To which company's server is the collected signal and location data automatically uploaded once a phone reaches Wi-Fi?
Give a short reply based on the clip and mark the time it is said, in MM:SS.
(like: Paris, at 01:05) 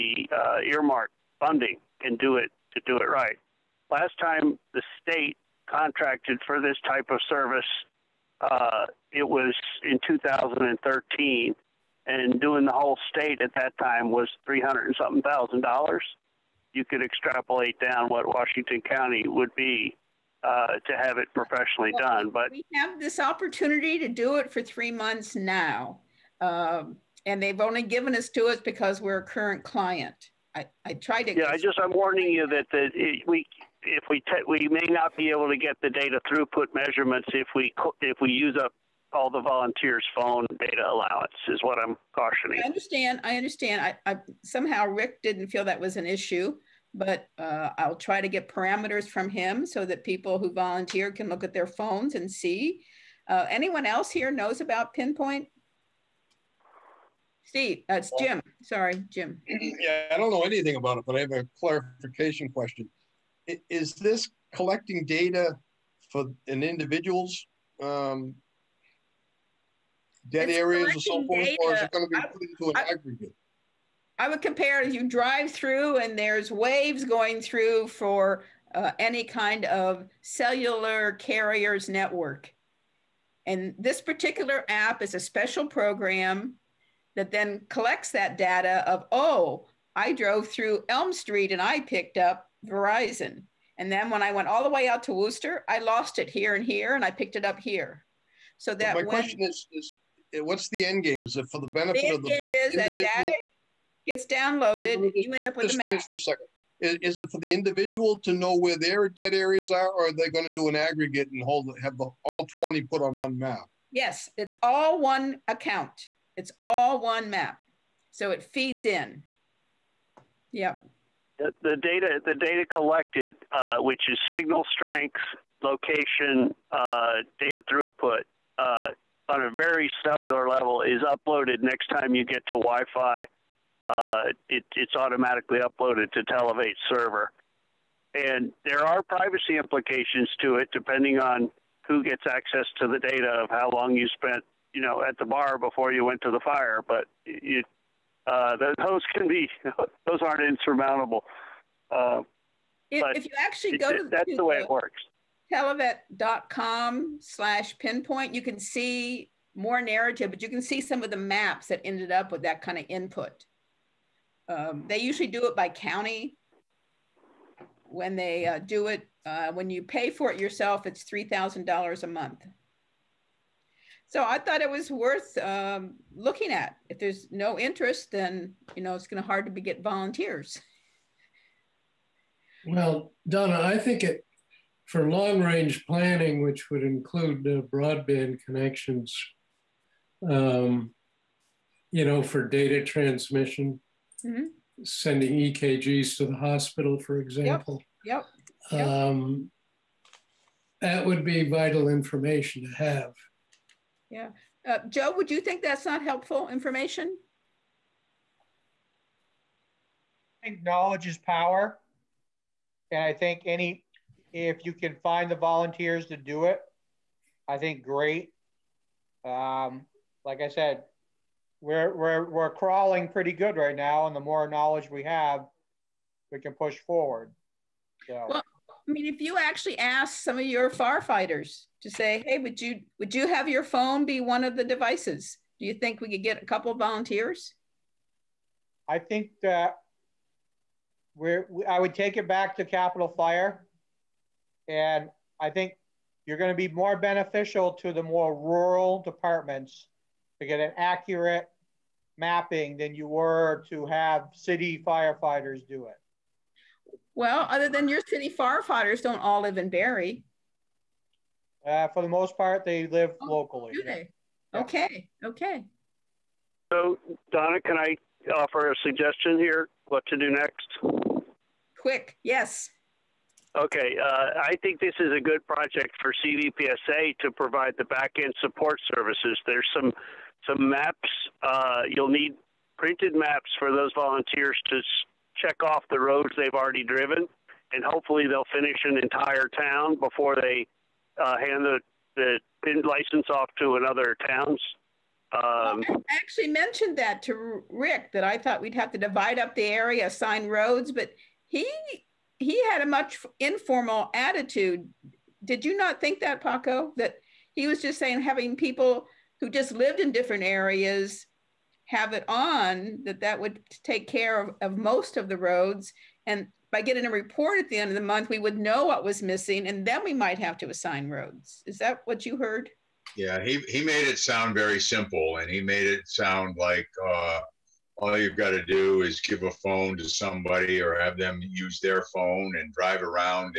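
Televate, at 02:16.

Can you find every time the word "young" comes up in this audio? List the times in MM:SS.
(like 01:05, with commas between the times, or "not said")
not said.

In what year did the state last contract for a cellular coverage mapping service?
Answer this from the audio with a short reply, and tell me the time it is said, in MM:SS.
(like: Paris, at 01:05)
2013, at 00:10.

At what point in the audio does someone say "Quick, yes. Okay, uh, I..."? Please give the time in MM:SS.
04:31.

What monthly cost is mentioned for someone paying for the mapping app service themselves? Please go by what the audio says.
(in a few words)
$3,000.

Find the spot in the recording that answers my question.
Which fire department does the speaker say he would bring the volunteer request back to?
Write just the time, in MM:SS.
04:02.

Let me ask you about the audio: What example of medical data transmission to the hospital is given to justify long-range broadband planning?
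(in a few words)
EKGs.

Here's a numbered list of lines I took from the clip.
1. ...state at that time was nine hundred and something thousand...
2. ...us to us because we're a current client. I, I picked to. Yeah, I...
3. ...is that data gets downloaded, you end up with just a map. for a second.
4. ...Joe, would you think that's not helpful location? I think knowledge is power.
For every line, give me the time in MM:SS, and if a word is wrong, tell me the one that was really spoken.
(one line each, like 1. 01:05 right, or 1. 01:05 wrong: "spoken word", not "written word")
1. 00:13 wrong: "three", not "nine"
2. 00:28 wrong: "tried", not "picked"
3. 01:42 right
4. 03:24 wrong: "information", not "location".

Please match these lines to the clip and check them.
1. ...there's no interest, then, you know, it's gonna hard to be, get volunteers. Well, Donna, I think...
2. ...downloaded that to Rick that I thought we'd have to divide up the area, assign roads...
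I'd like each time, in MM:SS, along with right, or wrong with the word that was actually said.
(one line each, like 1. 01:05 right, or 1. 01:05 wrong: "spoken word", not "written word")
1. 02:56 right
2. 04:56 wrong: "mentioned", not "downloaded".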